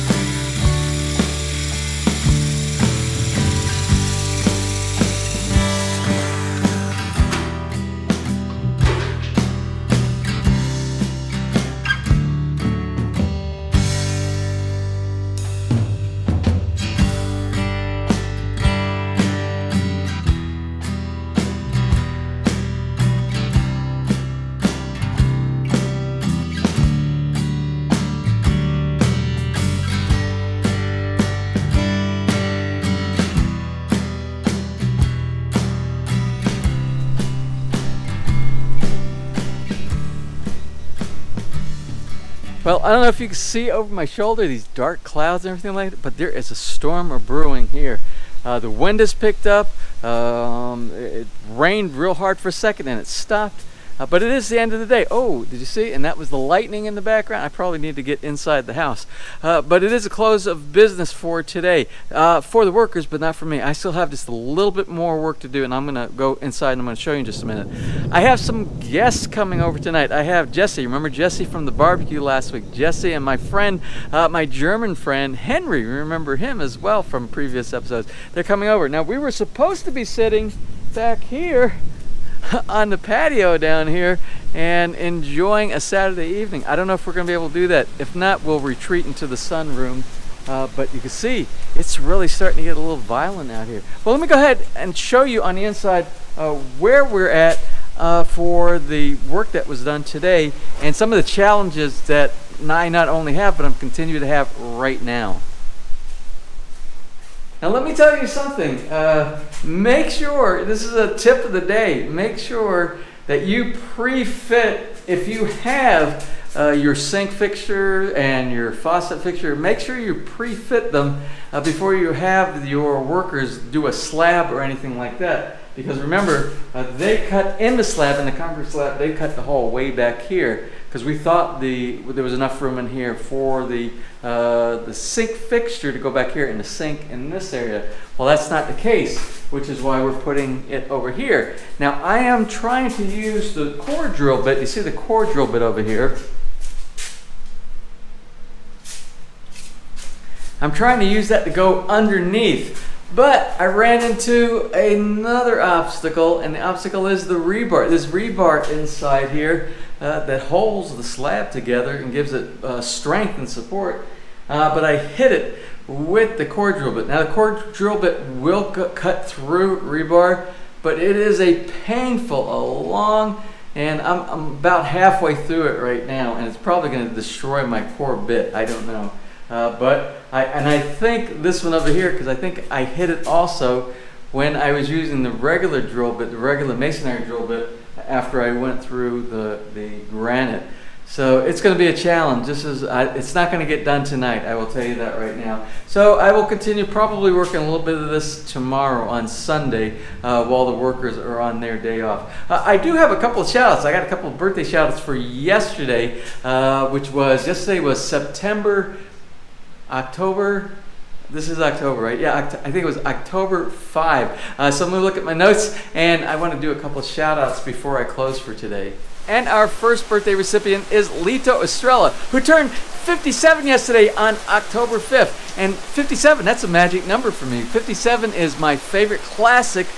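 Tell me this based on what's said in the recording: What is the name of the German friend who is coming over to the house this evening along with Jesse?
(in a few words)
Henry.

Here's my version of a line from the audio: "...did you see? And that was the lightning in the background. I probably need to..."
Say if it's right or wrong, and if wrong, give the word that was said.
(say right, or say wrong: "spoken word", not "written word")
right.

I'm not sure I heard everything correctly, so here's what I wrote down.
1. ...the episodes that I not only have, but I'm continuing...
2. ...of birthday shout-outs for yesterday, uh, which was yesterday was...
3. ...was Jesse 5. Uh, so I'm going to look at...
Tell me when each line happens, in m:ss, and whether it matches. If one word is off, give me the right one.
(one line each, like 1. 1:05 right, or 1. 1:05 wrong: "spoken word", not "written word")
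1. 1:41 wrong: "challenges", not "episodes"
2. 3:24 right
3. 3:32 wrong: "October", not "Jesse".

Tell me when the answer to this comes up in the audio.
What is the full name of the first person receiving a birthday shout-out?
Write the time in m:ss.
3:41.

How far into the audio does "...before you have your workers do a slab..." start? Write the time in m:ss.
2:01.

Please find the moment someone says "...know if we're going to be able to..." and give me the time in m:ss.
1:26.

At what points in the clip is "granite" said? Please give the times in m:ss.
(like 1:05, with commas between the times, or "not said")
3:10.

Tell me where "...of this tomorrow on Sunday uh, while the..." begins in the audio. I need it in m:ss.
3:17.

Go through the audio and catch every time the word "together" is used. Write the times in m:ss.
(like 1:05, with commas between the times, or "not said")
2:41.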